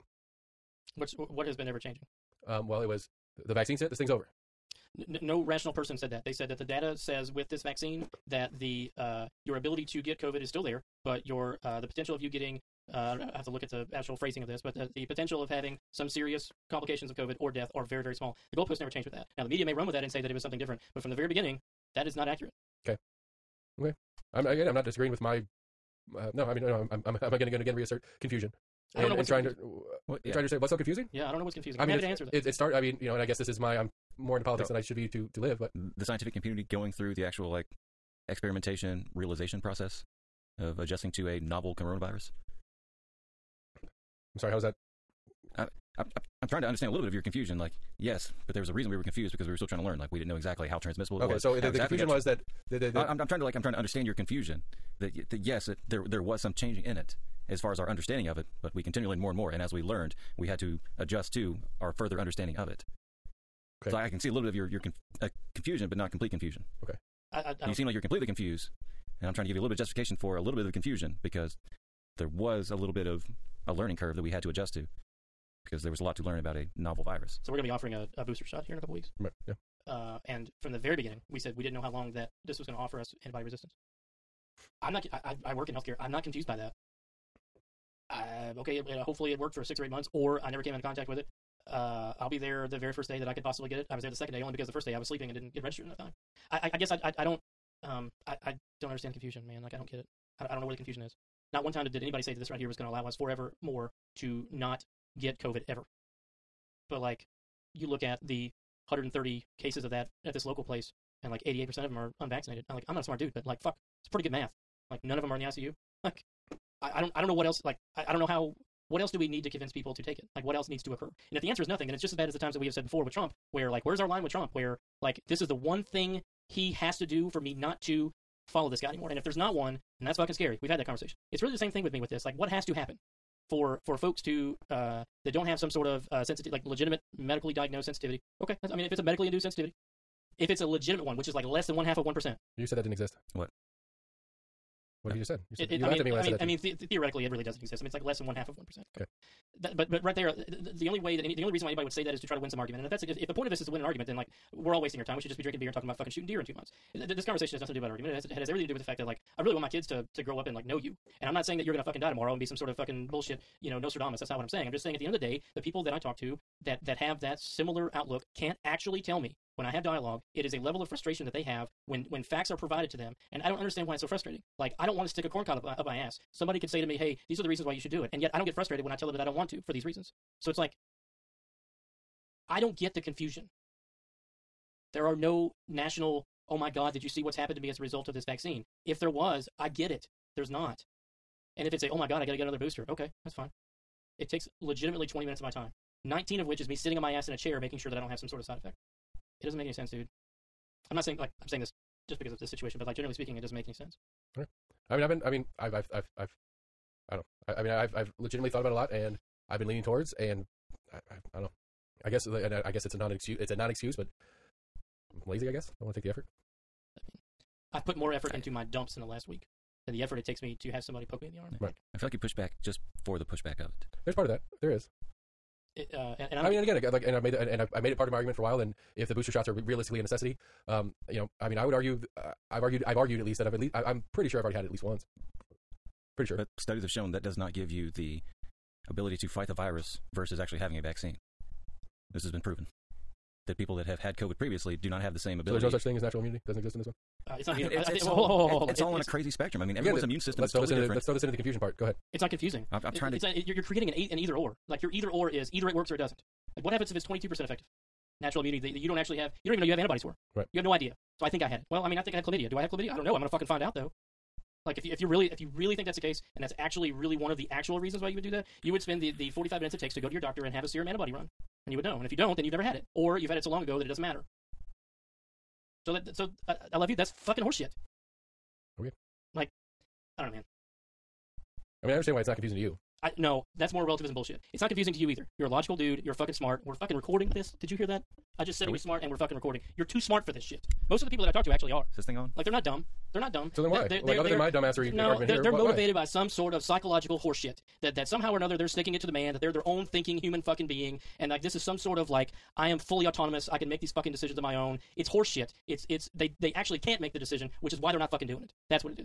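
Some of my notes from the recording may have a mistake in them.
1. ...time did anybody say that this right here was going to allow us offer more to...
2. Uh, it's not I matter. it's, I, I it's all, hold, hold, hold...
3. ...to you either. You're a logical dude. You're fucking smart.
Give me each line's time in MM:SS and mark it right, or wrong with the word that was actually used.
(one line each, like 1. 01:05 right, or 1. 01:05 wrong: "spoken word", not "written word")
1. 01:41 wrong: "forever", not "offer"
2. 04:07 wrong: "either", not "matter"
3. 04:44 right.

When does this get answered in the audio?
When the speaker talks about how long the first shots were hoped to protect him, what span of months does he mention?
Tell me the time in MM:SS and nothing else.
01:29.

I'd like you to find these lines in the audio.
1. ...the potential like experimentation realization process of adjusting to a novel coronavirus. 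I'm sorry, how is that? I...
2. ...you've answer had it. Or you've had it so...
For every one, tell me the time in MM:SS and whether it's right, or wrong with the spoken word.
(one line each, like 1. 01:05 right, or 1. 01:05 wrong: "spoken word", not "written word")
1. 00:37 wrong: "actual", not "potential"
2. 04:32 wrong: "never", not "answer".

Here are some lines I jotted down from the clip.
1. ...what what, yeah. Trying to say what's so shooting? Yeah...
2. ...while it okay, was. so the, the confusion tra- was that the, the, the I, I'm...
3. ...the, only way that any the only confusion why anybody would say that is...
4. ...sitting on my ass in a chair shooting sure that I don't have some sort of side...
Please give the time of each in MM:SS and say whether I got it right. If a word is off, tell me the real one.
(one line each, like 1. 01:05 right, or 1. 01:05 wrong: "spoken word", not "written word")
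1. 00:29 wrong: "confusing", not "shooting"
2. 00:50 wrong: "transmissible", not "while"
3. 02:30 wrong: "reason", not "confusion"
4. 03:16 wrong: "making", not "shooting".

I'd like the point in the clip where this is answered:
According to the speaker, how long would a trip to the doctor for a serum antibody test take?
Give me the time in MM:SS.
04:29.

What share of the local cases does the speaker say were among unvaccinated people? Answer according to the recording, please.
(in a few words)
88%.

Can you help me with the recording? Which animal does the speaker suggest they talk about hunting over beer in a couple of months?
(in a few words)
deer.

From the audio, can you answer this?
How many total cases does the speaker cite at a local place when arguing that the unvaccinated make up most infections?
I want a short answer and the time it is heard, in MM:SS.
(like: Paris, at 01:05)
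130, at 01:48.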